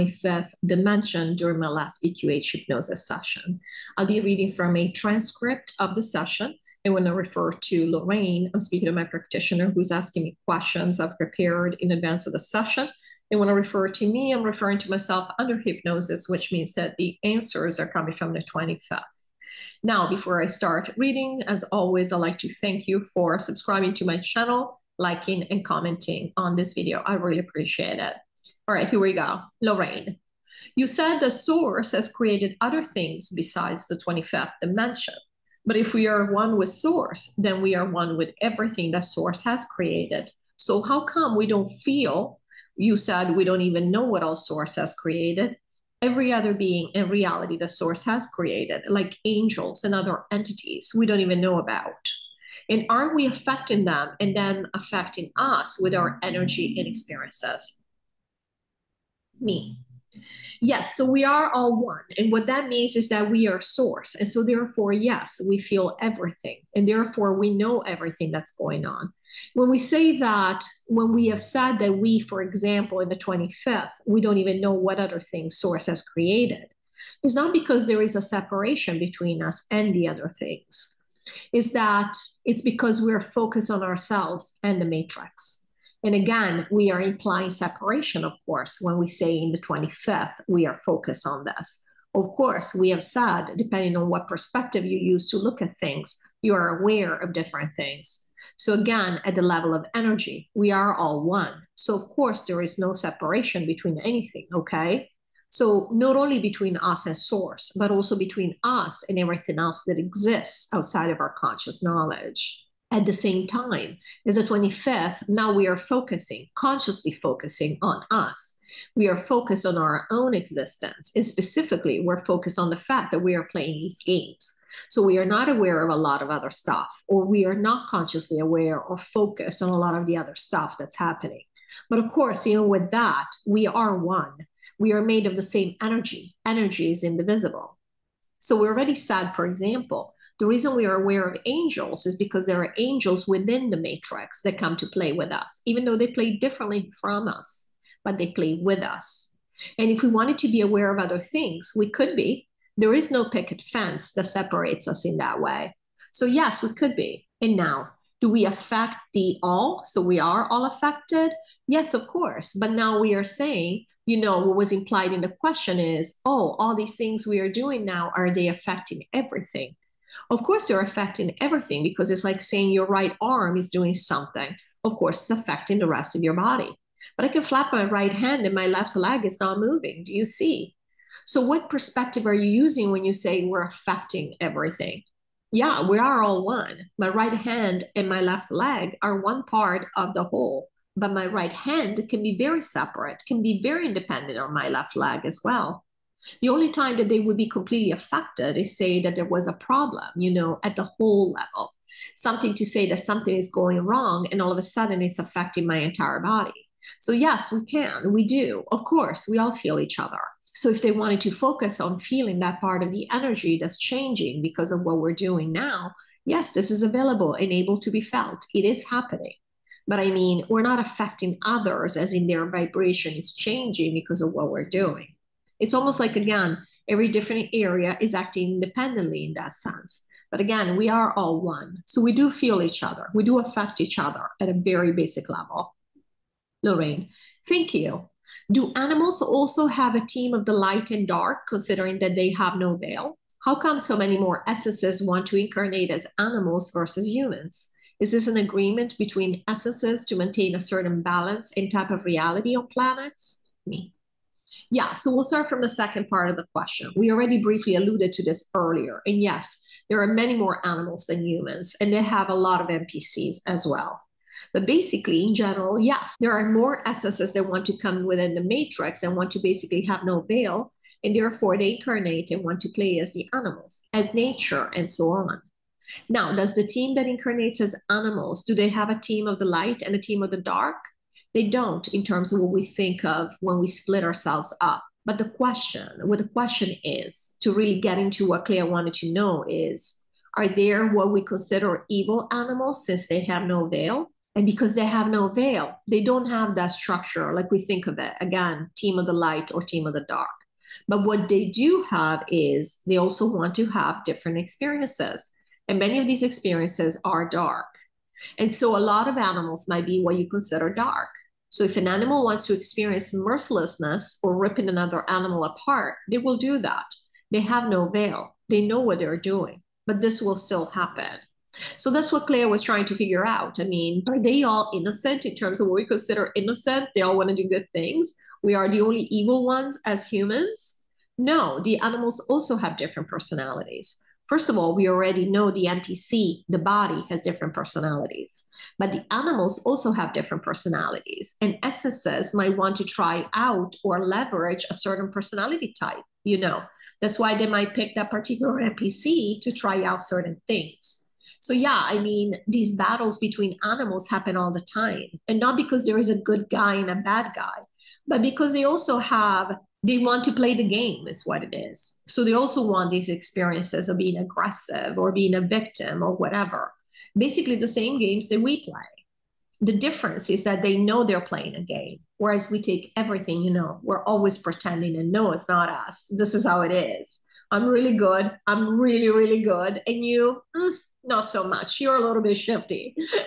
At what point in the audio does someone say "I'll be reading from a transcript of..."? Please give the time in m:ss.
0:03.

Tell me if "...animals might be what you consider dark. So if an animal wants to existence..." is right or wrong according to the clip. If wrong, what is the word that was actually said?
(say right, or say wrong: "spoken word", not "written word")
wrong: "experience", not "existence".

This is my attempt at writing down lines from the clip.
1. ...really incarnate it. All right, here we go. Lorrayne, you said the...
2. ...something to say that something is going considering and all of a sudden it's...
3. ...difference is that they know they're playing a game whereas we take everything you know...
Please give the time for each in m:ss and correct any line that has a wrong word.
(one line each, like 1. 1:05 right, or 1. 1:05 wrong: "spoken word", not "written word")
1. 0:27 wrong: "appreciate", not "incarnate"
2. 3:22 wrong: "wrong", not "considering"
3. 6:09 right.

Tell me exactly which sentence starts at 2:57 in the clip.
But I can flap my right hand and my left leg is not moving.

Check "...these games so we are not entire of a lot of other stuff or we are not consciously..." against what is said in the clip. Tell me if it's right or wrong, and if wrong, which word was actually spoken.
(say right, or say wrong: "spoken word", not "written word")
wrong: "aware", not "entire".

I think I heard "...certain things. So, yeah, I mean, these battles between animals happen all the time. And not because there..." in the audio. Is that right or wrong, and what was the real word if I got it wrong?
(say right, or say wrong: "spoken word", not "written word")
right.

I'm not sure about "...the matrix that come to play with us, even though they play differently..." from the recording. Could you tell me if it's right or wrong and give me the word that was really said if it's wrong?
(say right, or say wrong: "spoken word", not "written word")
right.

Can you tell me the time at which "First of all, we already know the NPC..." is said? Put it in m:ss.
5:34.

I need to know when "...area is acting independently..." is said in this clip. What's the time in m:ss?
3:47.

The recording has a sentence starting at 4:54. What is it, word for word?
And because they have no veil, they don't have that structure like we think of it.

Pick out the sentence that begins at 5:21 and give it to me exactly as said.
So that's what Clea was trying to figure out.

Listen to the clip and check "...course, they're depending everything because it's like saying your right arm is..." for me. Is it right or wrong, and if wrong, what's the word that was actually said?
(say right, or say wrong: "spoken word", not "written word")
wrong: "affecting", not "depending".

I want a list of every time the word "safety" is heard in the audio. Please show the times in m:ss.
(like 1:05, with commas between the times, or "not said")
not said.